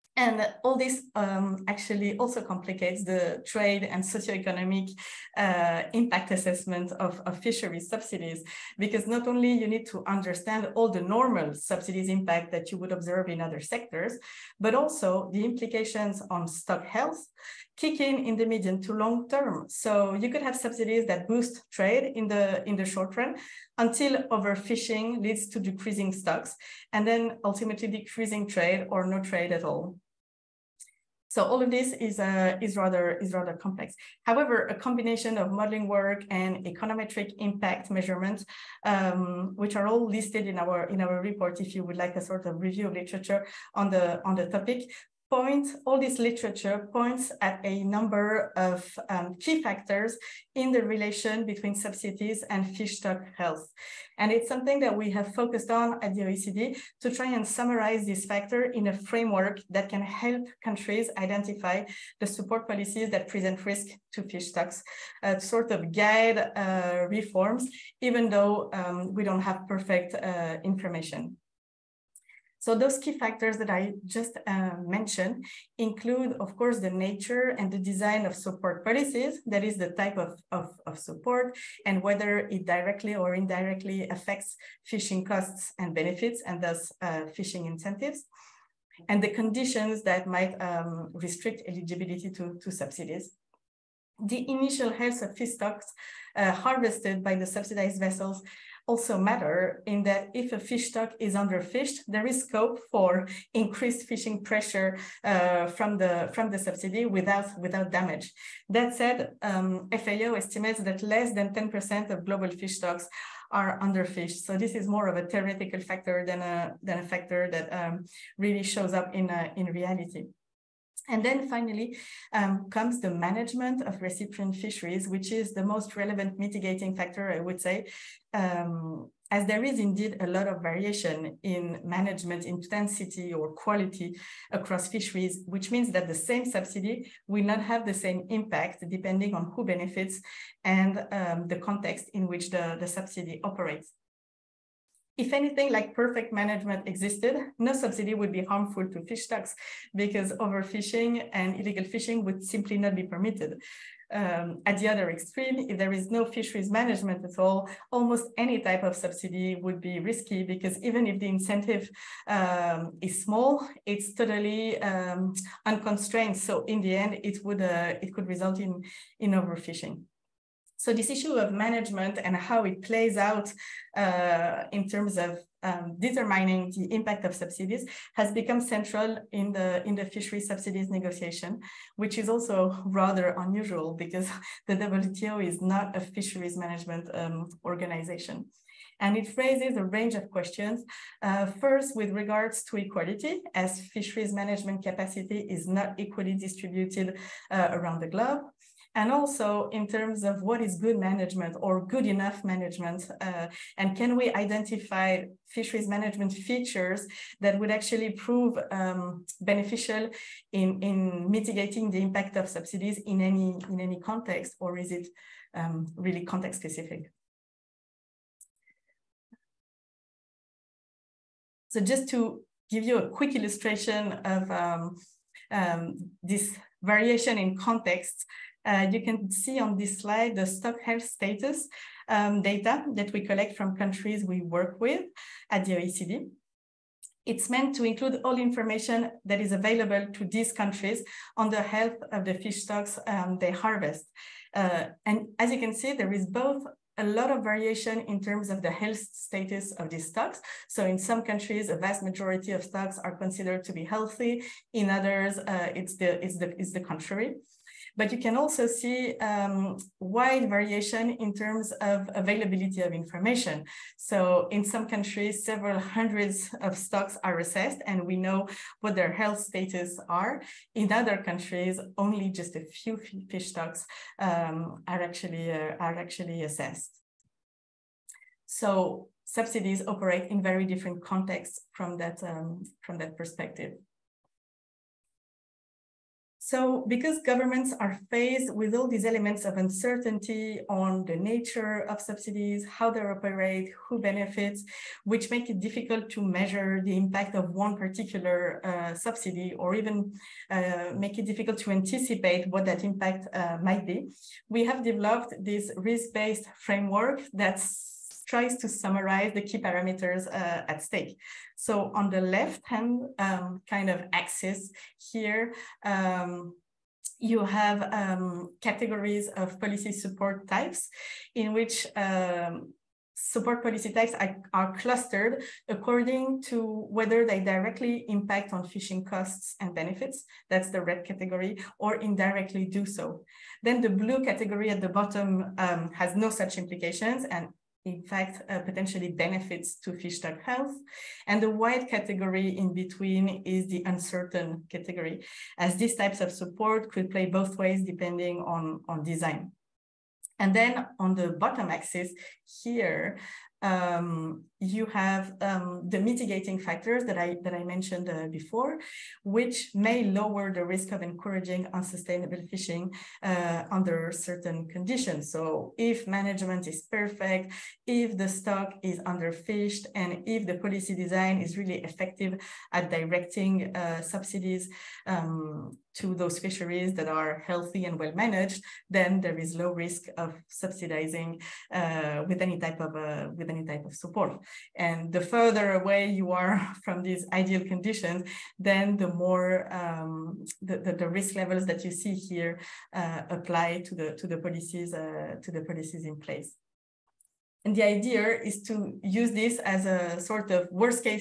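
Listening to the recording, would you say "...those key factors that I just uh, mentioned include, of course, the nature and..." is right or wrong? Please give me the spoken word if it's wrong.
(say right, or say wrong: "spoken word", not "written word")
right.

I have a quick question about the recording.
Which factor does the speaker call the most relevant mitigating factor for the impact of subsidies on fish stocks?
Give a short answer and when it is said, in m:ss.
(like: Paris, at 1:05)
management of recipient fisheries, at 2:03.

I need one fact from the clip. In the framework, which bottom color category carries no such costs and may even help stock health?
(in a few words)
blue.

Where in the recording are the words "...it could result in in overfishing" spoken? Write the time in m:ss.
2:47.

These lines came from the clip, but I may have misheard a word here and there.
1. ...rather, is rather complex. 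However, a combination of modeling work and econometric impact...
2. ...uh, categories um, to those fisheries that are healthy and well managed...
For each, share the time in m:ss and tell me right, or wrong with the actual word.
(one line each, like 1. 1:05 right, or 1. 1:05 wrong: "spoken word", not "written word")
1. 0:32 right
2. 6:13 wrong: "subsidies", not "categories".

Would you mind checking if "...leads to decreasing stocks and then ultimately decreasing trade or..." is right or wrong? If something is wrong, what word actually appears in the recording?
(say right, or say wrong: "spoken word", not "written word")
right.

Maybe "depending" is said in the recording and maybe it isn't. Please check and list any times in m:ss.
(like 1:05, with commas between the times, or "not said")
2:18, 5:47.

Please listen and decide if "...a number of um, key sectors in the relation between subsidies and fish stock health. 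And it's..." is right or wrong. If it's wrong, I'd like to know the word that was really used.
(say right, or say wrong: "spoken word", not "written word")
wrong: "factors", not "sectors".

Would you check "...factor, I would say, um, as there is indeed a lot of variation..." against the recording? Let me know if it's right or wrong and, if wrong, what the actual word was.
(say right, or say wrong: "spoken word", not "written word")
right.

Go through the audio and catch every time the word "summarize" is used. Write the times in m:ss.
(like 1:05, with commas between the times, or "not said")
0:57, 5:08.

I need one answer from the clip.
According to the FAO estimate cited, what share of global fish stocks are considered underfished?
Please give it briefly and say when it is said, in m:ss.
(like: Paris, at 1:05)
less than 10%, at 1:51.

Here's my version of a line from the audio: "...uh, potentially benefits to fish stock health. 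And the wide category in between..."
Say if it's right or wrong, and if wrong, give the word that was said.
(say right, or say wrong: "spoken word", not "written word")
right.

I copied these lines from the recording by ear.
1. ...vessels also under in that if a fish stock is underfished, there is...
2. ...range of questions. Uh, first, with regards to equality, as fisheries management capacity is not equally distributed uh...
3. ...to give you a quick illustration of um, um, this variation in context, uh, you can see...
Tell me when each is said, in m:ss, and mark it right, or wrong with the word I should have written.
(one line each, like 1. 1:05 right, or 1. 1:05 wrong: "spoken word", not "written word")
1. 1:37 wrong: "matter", not "under"
2. 3:09 right
3. 3:42 right.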